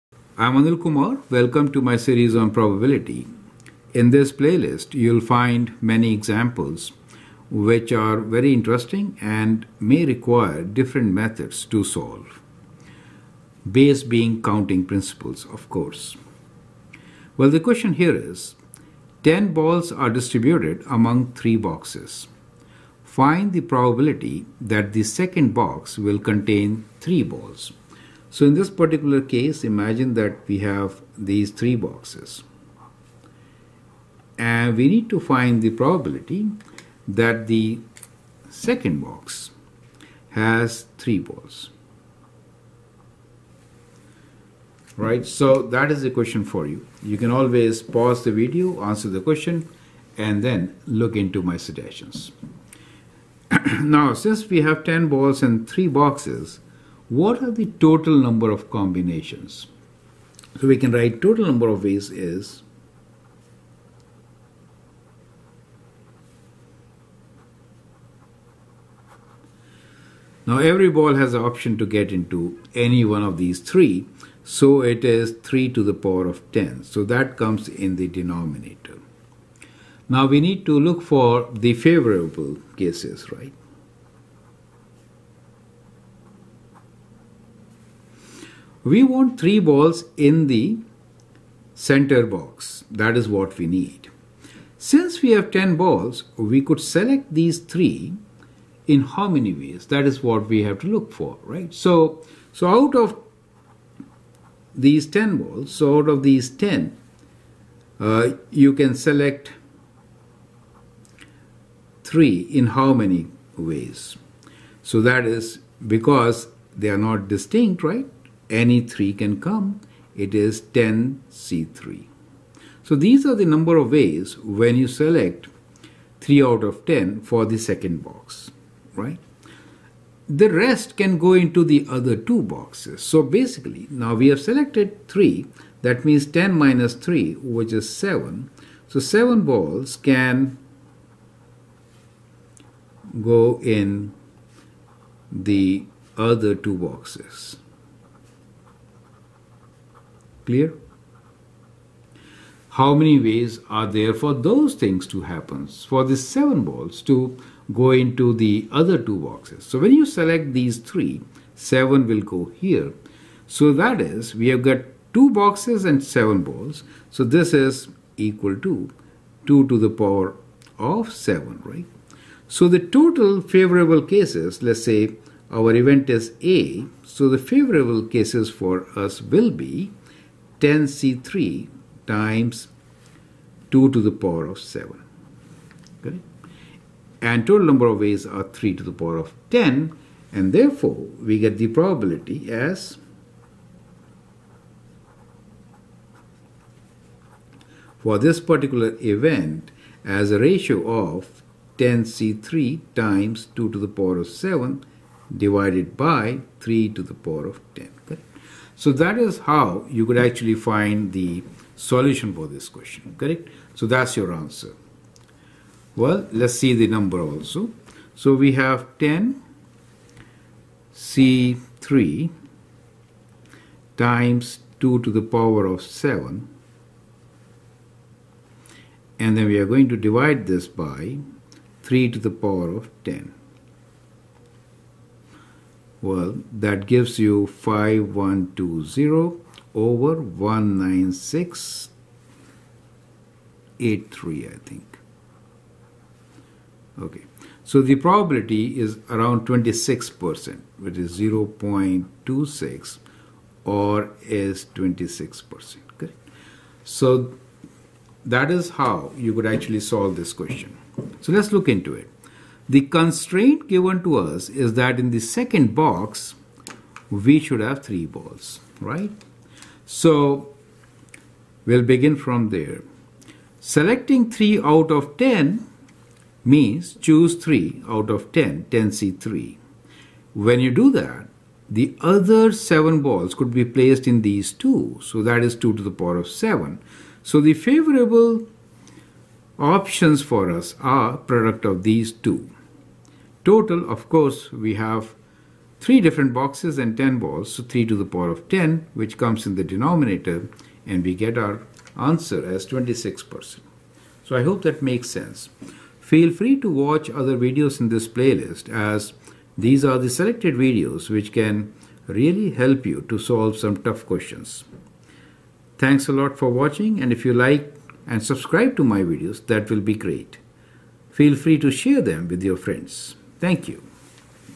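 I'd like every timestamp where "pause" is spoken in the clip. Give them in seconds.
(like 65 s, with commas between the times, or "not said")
47 s.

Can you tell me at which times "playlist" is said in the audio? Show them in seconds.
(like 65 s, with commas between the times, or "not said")
4 s, 308 s.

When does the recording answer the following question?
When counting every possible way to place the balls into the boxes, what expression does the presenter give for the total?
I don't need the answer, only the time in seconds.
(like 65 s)
75 s.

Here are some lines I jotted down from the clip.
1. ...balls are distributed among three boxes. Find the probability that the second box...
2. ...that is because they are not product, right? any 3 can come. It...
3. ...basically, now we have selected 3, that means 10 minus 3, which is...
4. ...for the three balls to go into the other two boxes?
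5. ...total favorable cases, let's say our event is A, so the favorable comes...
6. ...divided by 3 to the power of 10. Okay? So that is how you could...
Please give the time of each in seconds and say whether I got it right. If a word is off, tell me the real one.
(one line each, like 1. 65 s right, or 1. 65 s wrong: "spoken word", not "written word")
1. 19 s right
2. 115 s wrong: "distinct", not "product"
3. 133 s right
4. 155 s wrong: "seven", not "three"
5. 172 s wrong: "cases", not "comes"
6. 205 s right.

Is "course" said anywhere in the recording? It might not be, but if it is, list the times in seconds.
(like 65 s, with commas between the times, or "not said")
15 s, 294 s.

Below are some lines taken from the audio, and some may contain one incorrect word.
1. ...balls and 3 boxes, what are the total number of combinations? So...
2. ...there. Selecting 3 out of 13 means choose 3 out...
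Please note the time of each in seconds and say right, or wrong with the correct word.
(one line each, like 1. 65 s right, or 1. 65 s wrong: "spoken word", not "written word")
1. 55 s right
2. 272 s wrong: "10", not "13".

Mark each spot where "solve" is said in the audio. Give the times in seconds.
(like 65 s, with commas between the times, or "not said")
11 s, 259 s, 313 s.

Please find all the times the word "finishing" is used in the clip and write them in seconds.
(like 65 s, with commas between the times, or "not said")
not said.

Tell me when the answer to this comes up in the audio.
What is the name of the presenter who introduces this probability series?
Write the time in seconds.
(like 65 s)
0 s.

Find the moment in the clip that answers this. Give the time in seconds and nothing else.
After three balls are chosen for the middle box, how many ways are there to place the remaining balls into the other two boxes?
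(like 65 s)
169 s.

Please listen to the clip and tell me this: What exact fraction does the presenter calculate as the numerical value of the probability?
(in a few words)
5120/19683.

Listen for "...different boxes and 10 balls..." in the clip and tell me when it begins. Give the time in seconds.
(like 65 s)
296 s.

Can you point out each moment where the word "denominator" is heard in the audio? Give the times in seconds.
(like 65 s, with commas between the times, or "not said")
78 s, 299 s.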